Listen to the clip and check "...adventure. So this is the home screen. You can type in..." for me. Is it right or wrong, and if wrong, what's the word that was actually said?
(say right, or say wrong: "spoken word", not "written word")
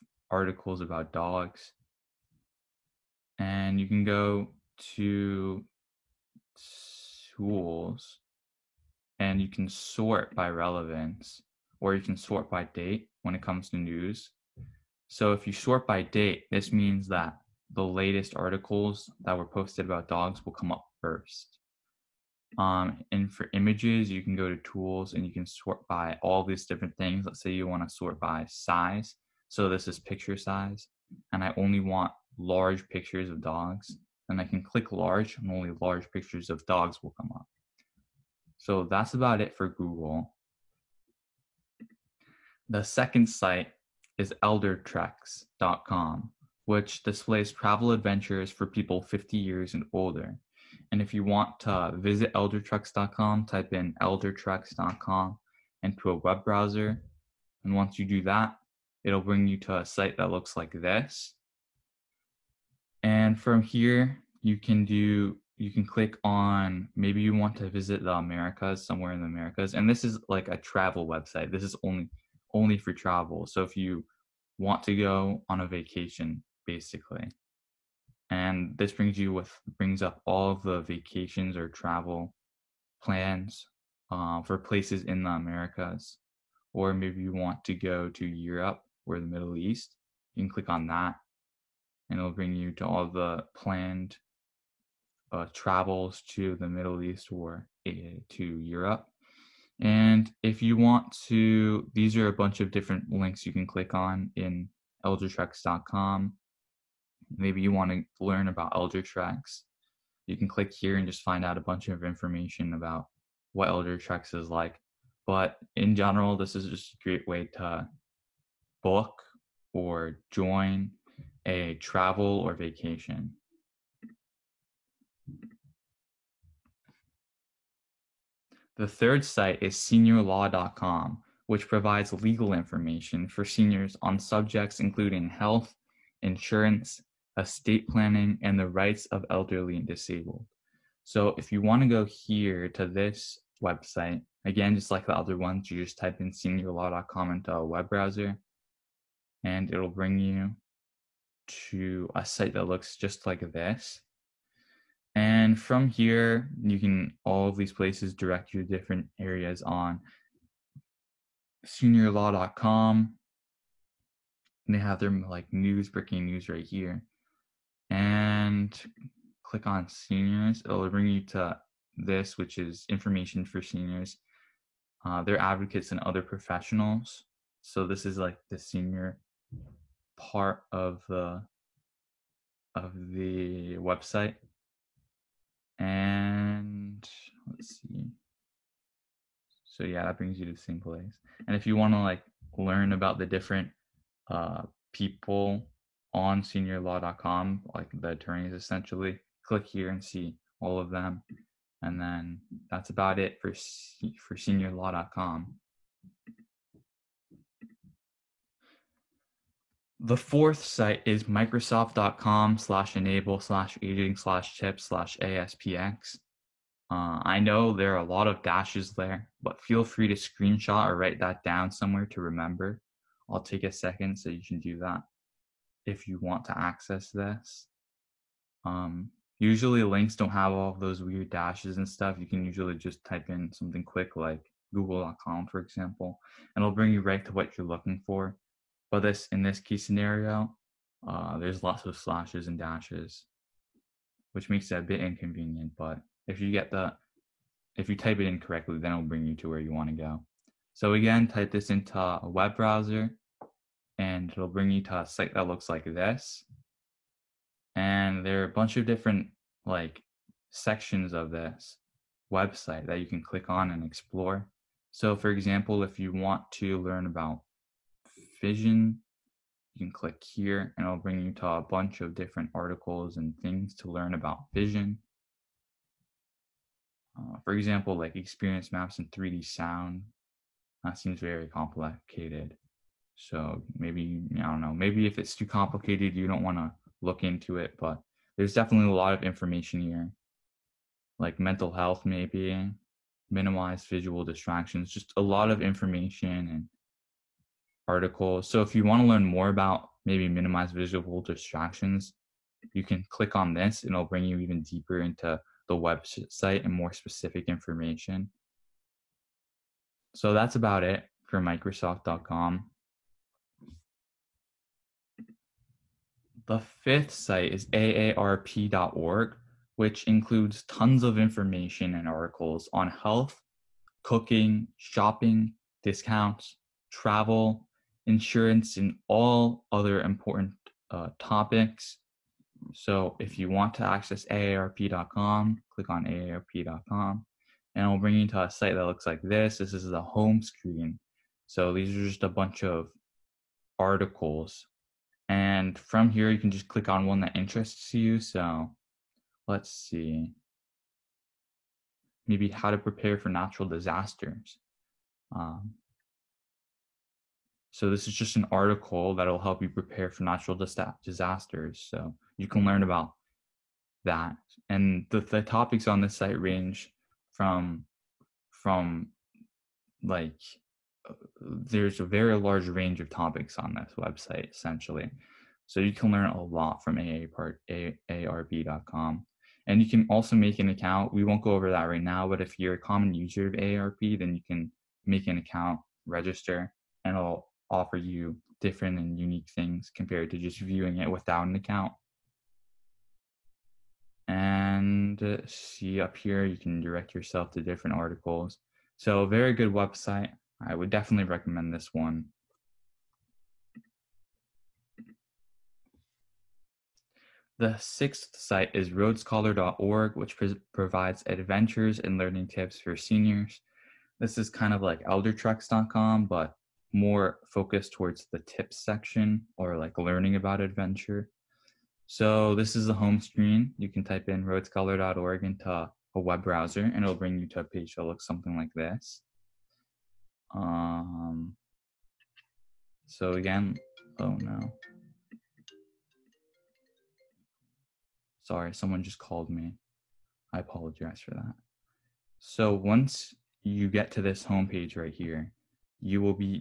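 right.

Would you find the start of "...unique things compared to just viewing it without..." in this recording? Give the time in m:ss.
6:29.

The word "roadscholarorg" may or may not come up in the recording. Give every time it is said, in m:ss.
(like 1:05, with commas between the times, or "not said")
6:48, 7:04.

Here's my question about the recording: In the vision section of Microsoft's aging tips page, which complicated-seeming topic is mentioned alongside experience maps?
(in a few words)
3D sound.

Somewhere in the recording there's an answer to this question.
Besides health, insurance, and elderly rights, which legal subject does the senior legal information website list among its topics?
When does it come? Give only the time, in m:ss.
2:17.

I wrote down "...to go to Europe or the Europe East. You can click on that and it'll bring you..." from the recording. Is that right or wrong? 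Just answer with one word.
wrong.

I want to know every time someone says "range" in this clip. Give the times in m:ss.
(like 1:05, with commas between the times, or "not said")
6:06, 6:12.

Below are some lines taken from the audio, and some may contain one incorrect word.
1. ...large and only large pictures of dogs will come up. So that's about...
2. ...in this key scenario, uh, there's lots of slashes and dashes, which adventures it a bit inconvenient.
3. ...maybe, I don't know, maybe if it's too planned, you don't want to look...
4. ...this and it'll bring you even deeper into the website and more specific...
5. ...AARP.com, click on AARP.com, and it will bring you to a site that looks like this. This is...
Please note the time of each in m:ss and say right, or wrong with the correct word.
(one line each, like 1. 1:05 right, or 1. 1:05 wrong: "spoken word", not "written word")
1. 0:34 right
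2. 3:59 wrong: "makes", not "adventures"
3. 4:43 wrong: "complicated", not "planned"
4. 5:03 right
5. 5:34 right.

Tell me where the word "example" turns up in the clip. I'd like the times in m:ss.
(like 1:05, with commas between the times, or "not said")
3:55, 4:25, 4:37.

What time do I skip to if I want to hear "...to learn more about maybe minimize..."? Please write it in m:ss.
4:59.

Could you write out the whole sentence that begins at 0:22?
Um, and for images, you can go to tools and you can sort by all these different things.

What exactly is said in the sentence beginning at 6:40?
I would definitely recommend this one.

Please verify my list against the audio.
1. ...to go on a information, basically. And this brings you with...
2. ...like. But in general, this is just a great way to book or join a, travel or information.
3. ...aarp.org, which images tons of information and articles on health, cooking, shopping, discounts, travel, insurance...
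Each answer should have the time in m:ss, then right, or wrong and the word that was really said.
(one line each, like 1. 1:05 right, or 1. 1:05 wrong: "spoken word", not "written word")
1. 1:14 wrong: "vacation", not "information"
2. 1:54 wrong: "vacation", not "information"
3. 5:17 wrong: "includes", not "images".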